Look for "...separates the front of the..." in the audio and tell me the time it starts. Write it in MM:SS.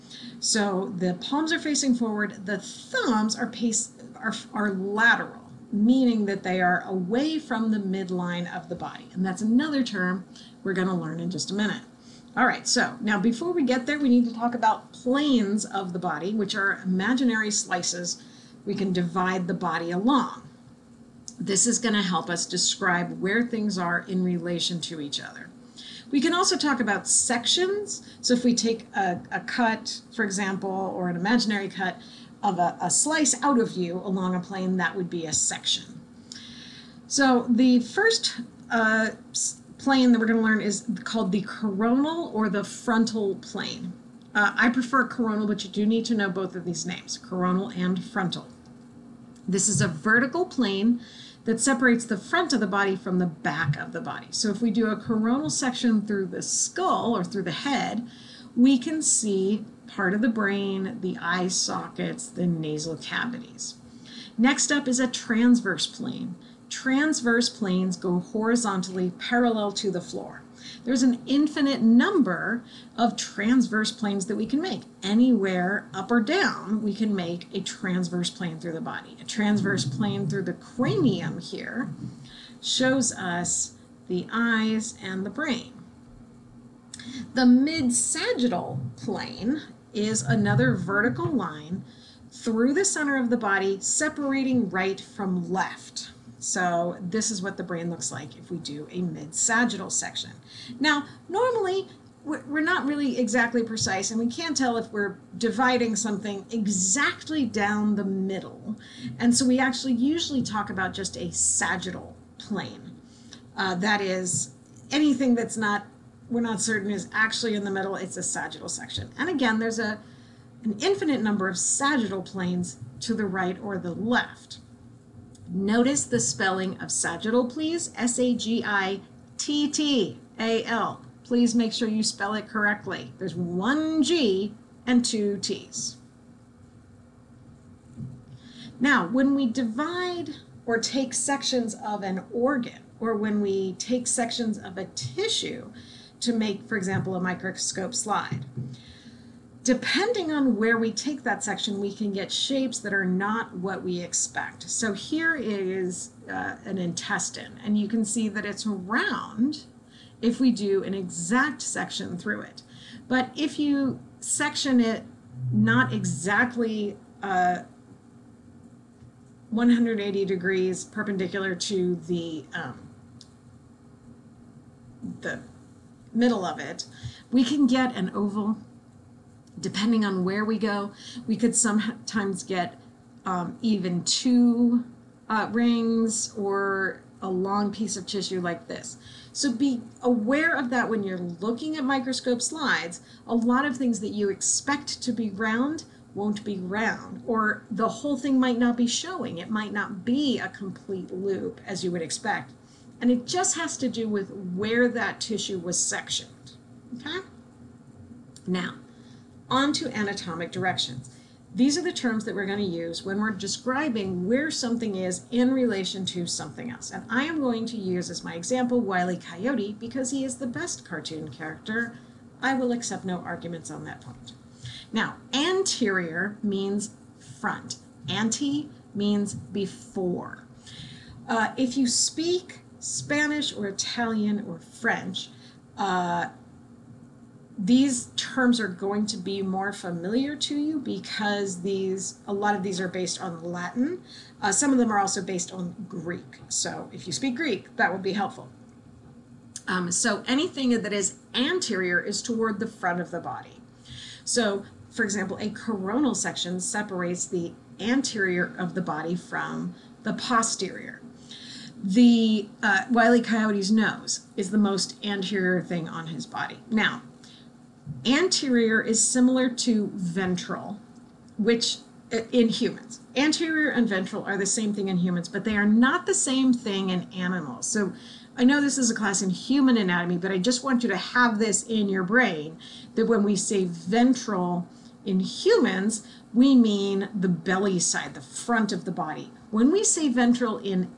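00:51.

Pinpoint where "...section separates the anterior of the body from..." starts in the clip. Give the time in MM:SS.
04:16.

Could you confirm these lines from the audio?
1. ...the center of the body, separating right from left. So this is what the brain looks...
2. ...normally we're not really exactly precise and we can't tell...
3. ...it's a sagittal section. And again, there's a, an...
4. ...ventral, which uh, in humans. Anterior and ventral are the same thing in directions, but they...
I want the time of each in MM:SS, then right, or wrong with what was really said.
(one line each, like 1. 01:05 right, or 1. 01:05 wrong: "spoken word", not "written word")
1. 01:32 right
2. 01:41 right
3. 01:57 right
4. 04:29 wrong: "humans", not "directions".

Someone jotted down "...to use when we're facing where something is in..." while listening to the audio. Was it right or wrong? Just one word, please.
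wrong.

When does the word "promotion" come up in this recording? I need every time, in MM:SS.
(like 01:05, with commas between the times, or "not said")
not said.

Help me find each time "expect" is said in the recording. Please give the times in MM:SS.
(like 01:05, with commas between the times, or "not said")
02:33, 03:14, 03:22.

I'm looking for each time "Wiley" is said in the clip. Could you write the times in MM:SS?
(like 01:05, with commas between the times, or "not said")
03:38, 04:22.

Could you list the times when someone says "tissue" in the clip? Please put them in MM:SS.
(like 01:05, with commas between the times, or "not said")
02:24, 03:08, 03:25.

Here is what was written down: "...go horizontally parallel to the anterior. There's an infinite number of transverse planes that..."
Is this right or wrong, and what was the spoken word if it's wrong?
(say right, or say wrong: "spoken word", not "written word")
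wrong: "floor", not "anterior".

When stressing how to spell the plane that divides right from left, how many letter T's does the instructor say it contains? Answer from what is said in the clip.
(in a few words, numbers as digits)
2.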